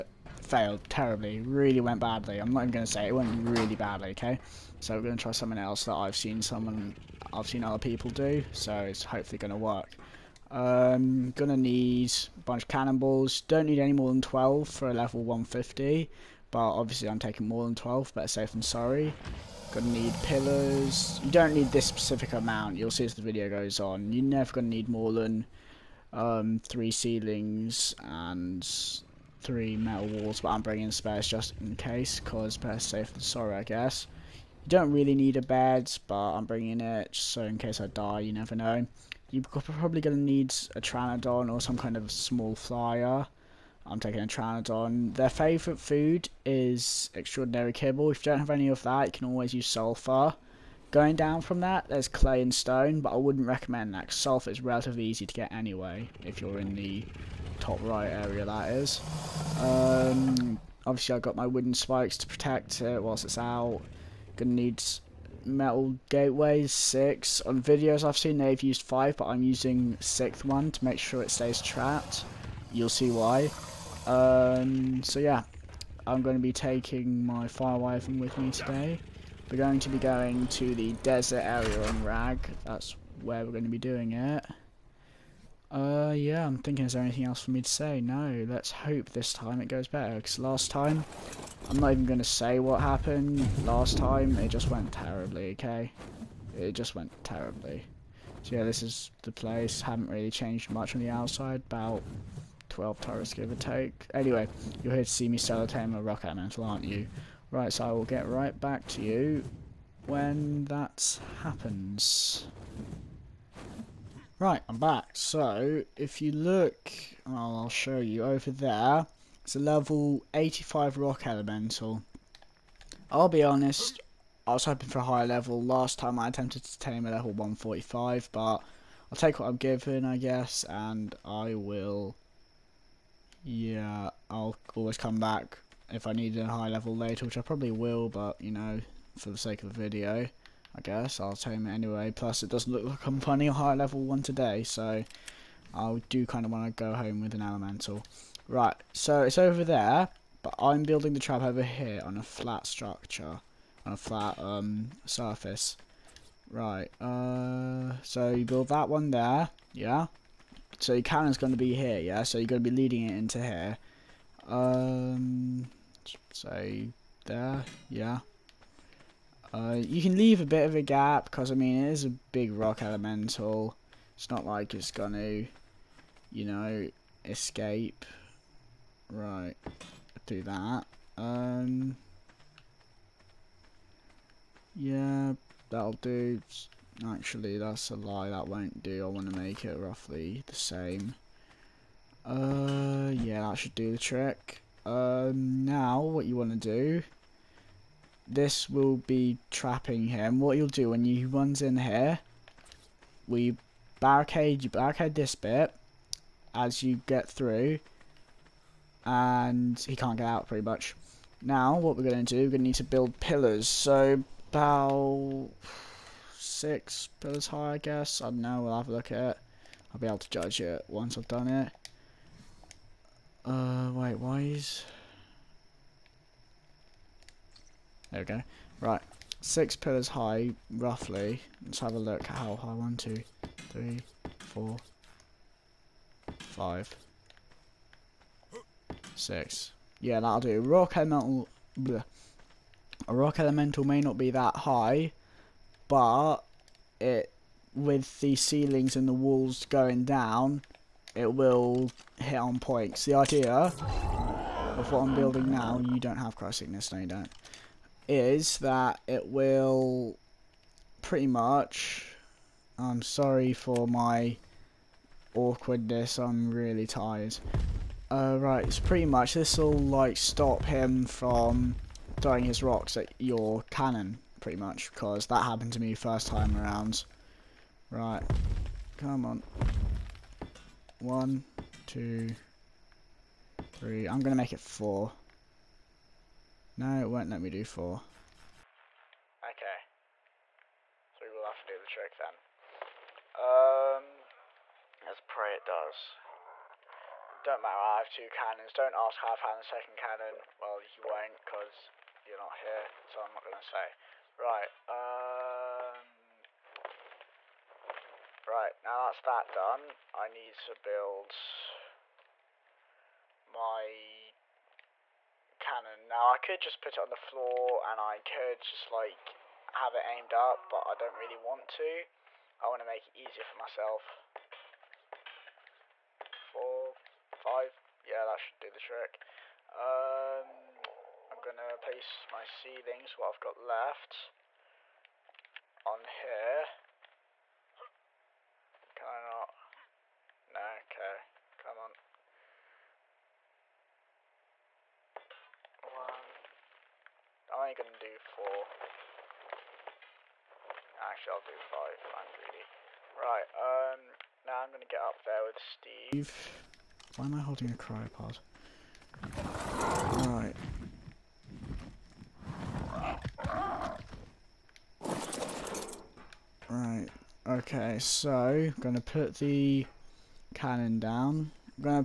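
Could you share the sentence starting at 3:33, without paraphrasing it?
So, about six pillars high, I guess.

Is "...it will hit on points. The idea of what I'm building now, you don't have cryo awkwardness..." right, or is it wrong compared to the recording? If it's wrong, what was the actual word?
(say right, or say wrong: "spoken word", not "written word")
wrong: "sickness", not "awkwardness".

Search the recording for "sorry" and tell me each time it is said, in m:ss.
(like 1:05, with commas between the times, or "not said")
0:18, 0:33, 4:23.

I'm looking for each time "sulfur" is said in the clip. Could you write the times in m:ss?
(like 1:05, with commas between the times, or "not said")
0:49, 0:54.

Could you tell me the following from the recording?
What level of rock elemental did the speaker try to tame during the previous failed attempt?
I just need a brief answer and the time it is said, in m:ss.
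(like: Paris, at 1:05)
145, at 2:07.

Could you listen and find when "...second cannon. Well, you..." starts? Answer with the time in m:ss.
4:59.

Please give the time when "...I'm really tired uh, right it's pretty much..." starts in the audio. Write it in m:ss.
4:26.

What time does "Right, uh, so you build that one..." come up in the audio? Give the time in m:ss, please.
2:36.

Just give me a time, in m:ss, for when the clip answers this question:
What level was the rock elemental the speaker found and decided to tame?
1:59.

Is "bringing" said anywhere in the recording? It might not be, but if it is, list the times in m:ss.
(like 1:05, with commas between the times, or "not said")
0:30, 0:36.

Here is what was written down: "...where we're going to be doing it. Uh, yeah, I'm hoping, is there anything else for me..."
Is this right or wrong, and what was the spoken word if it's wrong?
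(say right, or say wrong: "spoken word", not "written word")
wrong: "thinking", not "hoping".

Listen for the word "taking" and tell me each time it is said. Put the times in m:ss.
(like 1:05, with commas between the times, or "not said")
0:17, 0:43, 1:16.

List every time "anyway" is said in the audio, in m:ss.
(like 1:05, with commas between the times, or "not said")
0:55, 1:44, 2:21.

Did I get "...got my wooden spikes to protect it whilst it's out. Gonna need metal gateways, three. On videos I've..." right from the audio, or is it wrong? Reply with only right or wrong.
wrong.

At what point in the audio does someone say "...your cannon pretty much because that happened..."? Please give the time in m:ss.
4:33.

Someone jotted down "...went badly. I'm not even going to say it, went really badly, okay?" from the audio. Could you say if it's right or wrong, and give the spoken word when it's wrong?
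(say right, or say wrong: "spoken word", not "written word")
right.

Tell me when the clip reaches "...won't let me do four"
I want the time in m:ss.
4:47.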